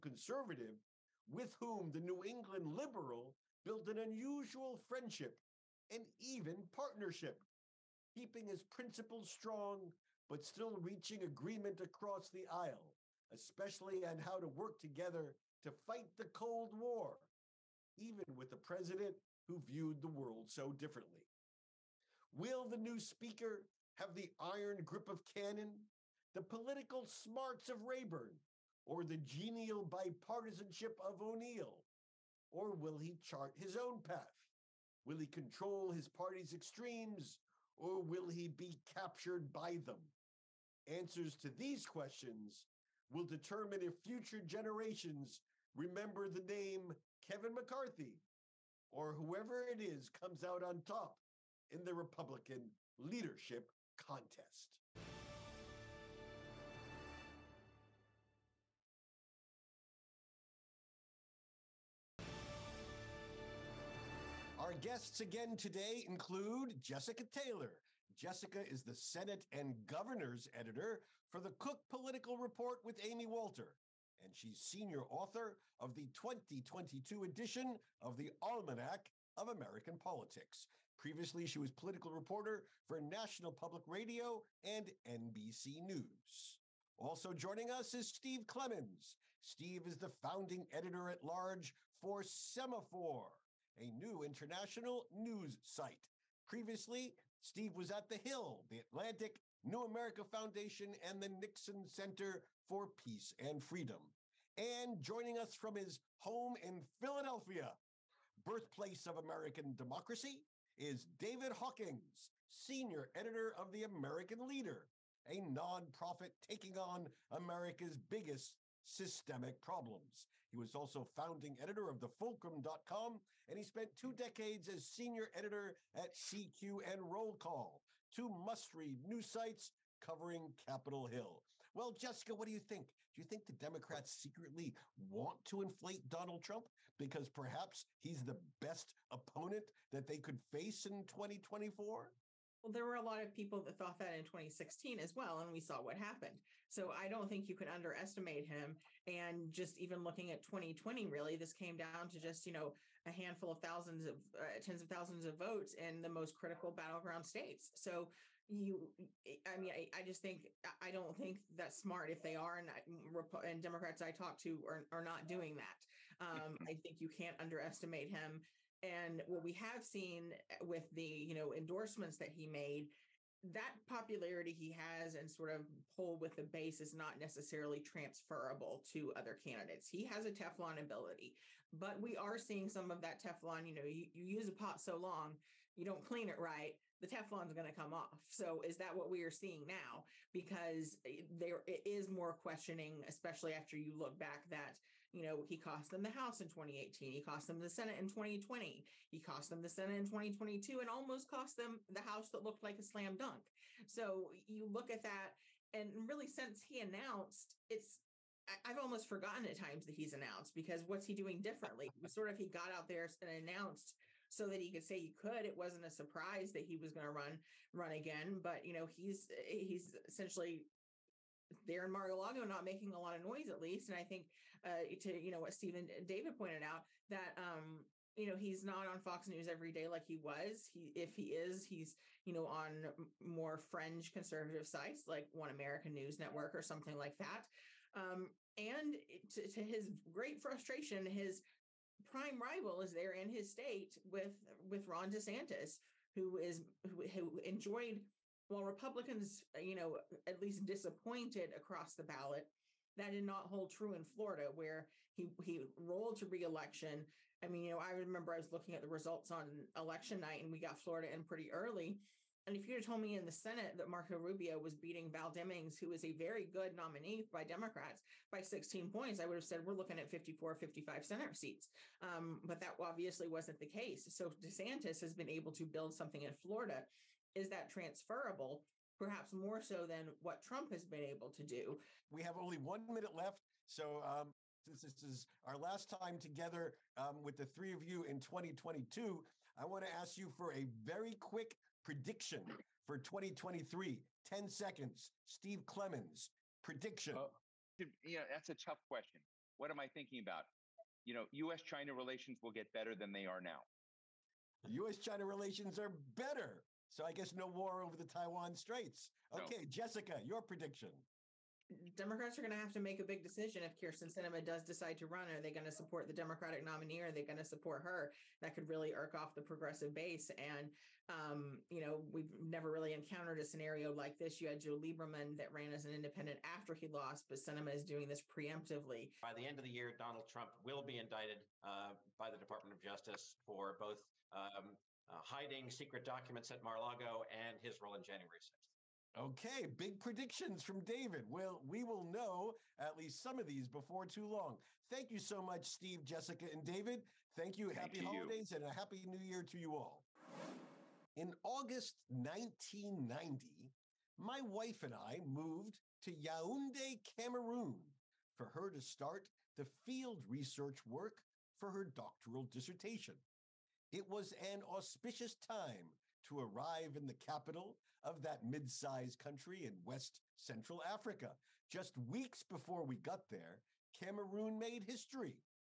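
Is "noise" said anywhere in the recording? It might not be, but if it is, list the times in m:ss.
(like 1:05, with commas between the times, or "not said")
3:43.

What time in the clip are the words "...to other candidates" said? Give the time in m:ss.
2:58.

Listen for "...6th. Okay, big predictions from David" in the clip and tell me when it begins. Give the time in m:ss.
5:38.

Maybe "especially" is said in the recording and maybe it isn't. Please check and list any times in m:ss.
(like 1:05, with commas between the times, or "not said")
0:13, 3:13.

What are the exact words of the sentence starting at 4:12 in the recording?
That did not hold true in Florida, where he he rolled to reelection.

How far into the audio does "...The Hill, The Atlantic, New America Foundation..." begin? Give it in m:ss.
1:38.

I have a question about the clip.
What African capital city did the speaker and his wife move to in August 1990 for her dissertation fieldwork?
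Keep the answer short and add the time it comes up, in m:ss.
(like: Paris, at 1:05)
Yaoundé, at 5:56.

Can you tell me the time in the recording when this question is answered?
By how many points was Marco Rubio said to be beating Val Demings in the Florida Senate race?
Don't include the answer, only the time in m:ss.
4:28.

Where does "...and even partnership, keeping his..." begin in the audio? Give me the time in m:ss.
0:05.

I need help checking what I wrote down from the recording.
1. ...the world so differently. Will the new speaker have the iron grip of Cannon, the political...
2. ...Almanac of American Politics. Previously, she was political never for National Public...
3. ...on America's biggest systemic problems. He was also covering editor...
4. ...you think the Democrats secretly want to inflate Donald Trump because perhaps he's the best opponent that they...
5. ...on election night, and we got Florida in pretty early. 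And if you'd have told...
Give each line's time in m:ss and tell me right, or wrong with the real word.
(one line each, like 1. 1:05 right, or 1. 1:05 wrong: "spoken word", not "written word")
1. 0:20 right
2. 1:18 wrong: "reporter", not "never"
3. 1:56 wrong: "founding", not "covering"
4. 2:13 right
5. 4:19 right.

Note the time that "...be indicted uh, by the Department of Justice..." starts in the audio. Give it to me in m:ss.
5:30.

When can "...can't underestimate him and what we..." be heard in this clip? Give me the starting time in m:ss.
2:47.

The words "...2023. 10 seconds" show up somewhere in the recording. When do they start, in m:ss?
4:52.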